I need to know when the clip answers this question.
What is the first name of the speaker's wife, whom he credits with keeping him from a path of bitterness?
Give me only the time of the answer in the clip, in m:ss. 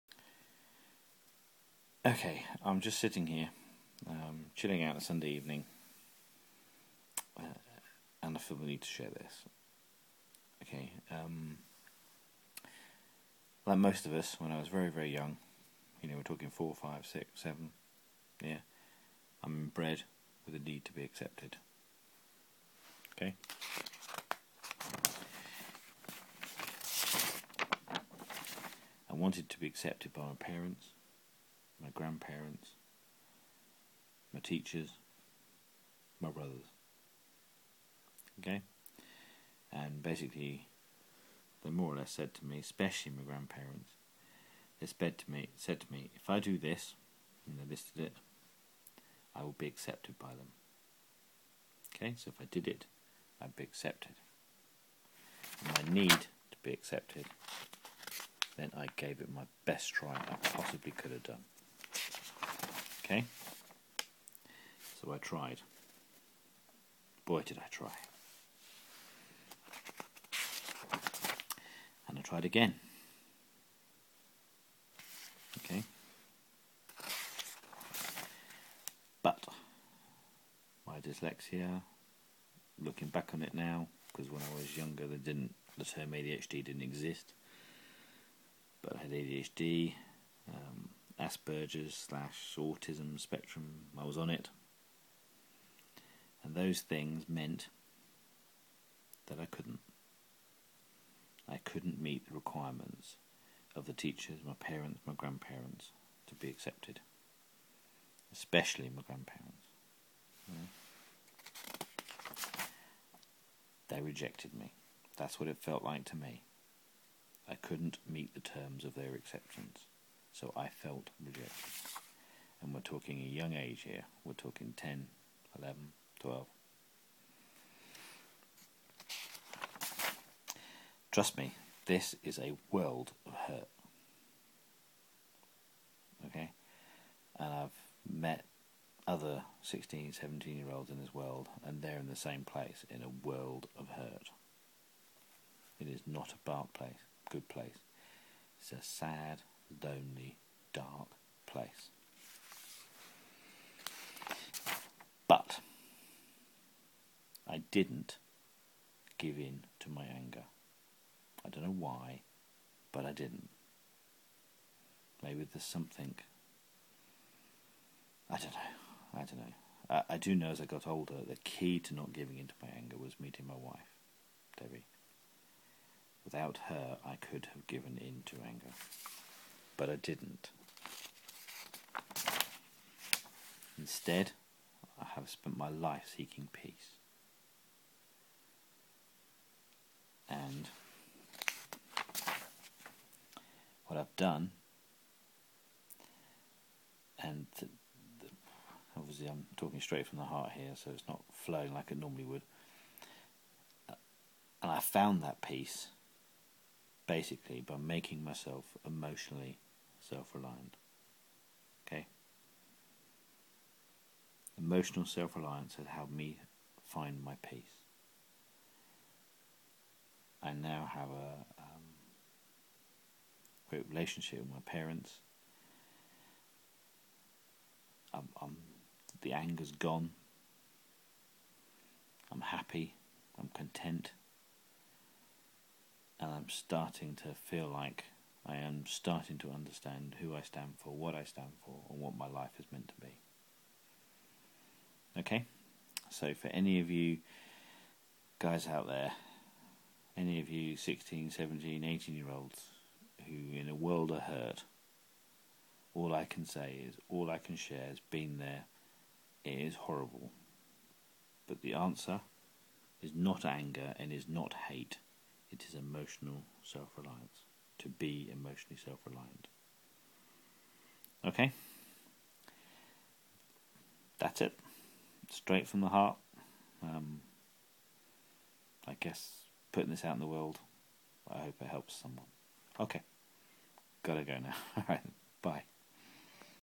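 2:54.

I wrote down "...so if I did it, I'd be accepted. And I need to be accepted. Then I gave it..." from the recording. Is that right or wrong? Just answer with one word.
right.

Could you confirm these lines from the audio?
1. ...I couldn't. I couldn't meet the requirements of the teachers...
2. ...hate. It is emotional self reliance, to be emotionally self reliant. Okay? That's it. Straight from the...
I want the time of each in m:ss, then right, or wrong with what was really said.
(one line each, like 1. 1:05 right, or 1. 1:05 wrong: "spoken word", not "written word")
1. 1:39 right
2. 4:24 right.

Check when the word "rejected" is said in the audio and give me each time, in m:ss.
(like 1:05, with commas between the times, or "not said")
1:54, 2:01.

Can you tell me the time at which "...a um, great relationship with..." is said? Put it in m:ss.
3:41.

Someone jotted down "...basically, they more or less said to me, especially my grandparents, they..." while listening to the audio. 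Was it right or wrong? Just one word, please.
right.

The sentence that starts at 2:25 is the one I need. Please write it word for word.
It is not a bad place, good place.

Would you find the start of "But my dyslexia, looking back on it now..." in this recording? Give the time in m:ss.
1:19.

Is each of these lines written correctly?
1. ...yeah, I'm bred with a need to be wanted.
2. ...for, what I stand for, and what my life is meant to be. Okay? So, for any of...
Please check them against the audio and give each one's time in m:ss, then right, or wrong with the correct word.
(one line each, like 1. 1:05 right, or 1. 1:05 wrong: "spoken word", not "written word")
1. 0:18 wrong: "accepted", not "wanted"
2. 4:00 right.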